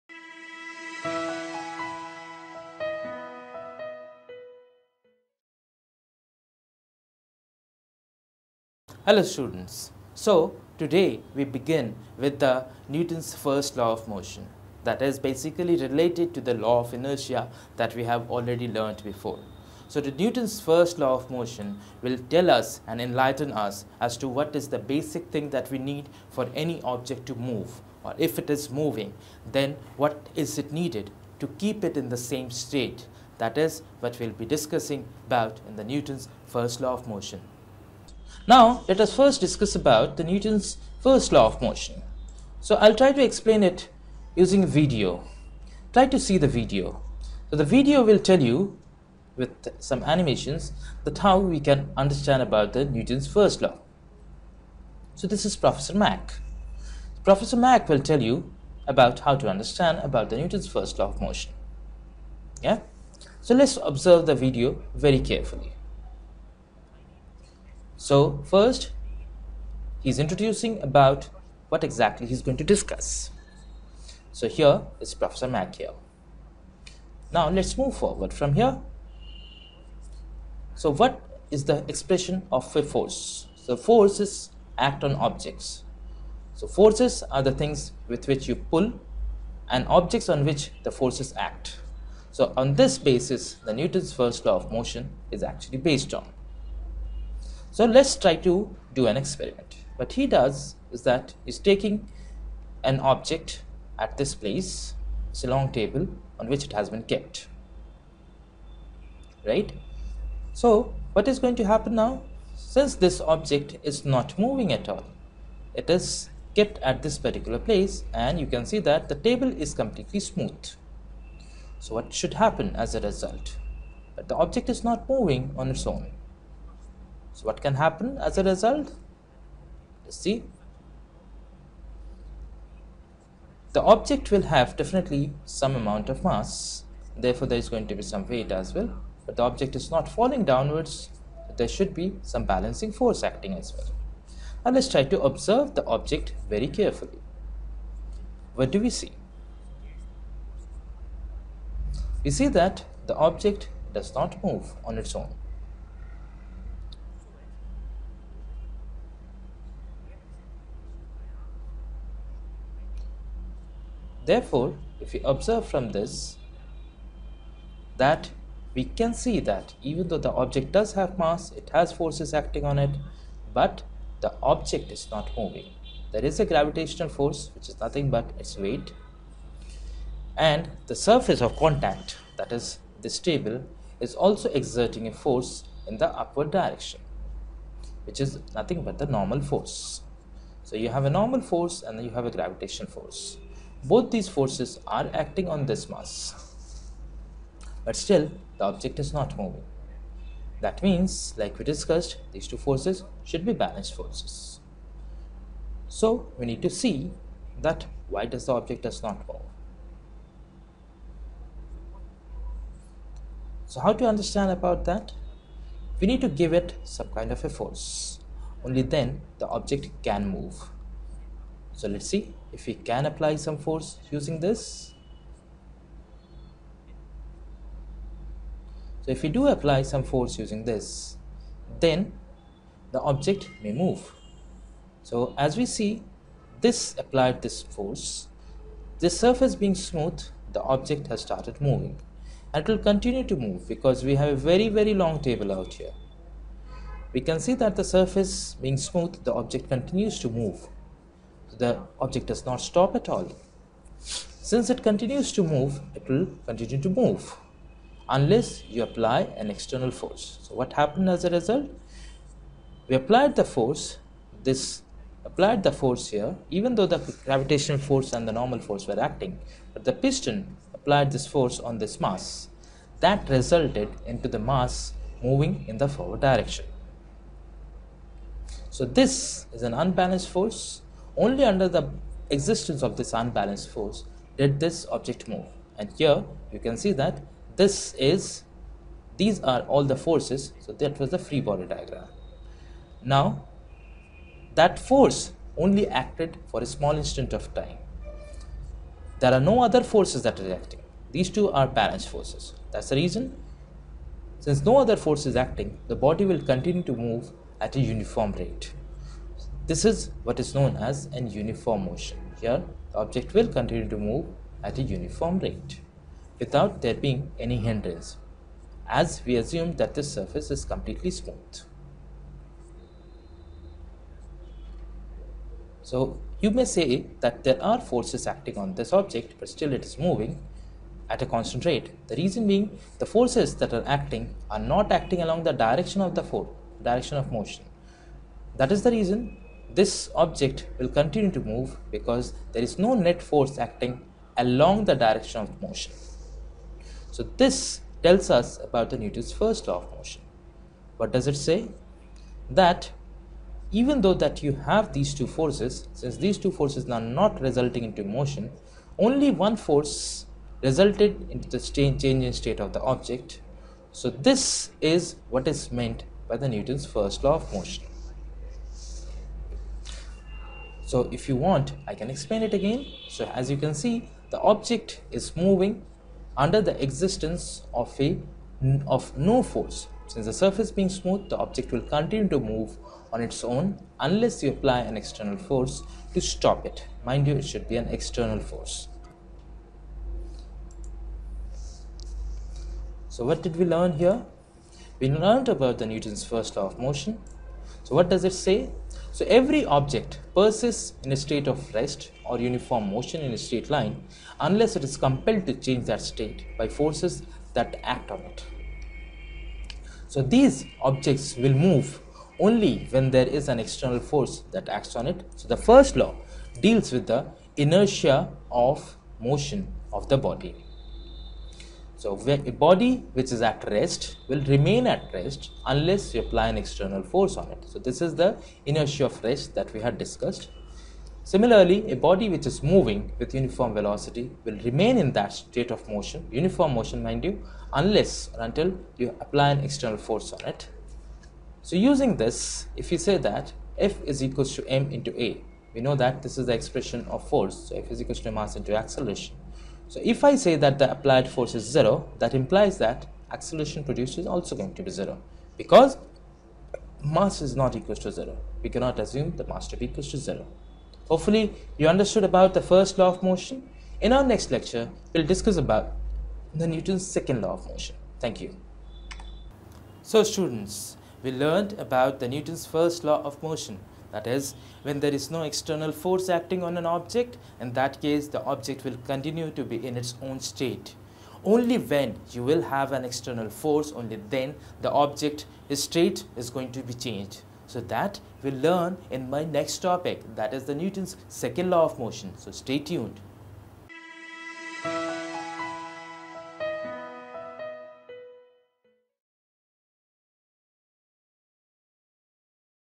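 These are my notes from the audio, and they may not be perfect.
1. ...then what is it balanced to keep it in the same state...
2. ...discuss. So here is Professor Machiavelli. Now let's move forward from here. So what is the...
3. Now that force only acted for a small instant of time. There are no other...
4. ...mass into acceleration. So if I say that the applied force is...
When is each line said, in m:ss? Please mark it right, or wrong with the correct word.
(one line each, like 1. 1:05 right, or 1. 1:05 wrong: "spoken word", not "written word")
1. 0:29 wrong: "needed", not "balanced"
2. 1:12 right
3. 4:53 right
4. 7:28 right.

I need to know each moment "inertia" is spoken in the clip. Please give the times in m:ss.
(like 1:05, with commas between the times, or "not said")
0:16, 6:57, 7:08.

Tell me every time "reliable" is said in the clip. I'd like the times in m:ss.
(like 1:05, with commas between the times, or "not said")
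not said.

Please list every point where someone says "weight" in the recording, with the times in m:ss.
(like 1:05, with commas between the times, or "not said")
2:18, 2:58.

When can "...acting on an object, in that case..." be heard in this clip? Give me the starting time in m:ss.
7:56.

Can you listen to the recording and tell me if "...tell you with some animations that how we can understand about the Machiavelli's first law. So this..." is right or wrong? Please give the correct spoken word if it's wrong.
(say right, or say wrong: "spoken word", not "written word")
wrong: "Newton", not "Machiavelli".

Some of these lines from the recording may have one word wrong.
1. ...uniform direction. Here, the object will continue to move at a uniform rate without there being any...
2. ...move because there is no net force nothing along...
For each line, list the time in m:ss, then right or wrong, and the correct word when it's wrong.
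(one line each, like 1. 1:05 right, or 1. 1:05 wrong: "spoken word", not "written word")
1. 5:11 wrong: "motion", not "direction"
2. 5:41 wrong: "acting", not "nothing".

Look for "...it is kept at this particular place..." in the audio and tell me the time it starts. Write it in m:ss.
1:55.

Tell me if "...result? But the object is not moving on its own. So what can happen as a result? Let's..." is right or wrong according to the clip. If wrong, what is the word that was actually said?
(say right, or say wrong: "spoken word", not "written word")
right.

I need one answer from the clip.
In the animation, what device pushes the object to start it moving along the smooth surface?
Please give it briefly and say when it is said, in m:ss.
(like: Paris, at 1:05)
piston, at 4:29.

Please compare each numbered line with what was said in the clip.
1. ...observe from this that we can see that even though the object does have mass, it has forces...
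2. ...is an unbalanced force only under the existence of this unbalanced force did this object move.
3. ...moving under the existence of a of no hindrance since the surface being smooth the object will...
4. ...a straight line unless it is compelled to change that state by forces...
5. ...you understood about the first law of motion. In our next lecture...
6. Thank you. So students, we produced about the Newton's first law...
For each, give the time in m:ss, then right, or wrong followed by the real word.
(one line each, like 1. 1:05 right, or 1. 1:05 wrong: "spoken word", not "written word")
1. 2:45 right
2. 4:39 right
3. 6:15 wrong: "force", not "hindrance"
4. 6:43 right
5. 7:41 right
6. 7:48 wrong: "learned", not "produced".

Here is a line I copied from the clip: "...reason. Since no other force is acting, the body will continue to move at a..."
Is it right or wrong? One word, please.
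right.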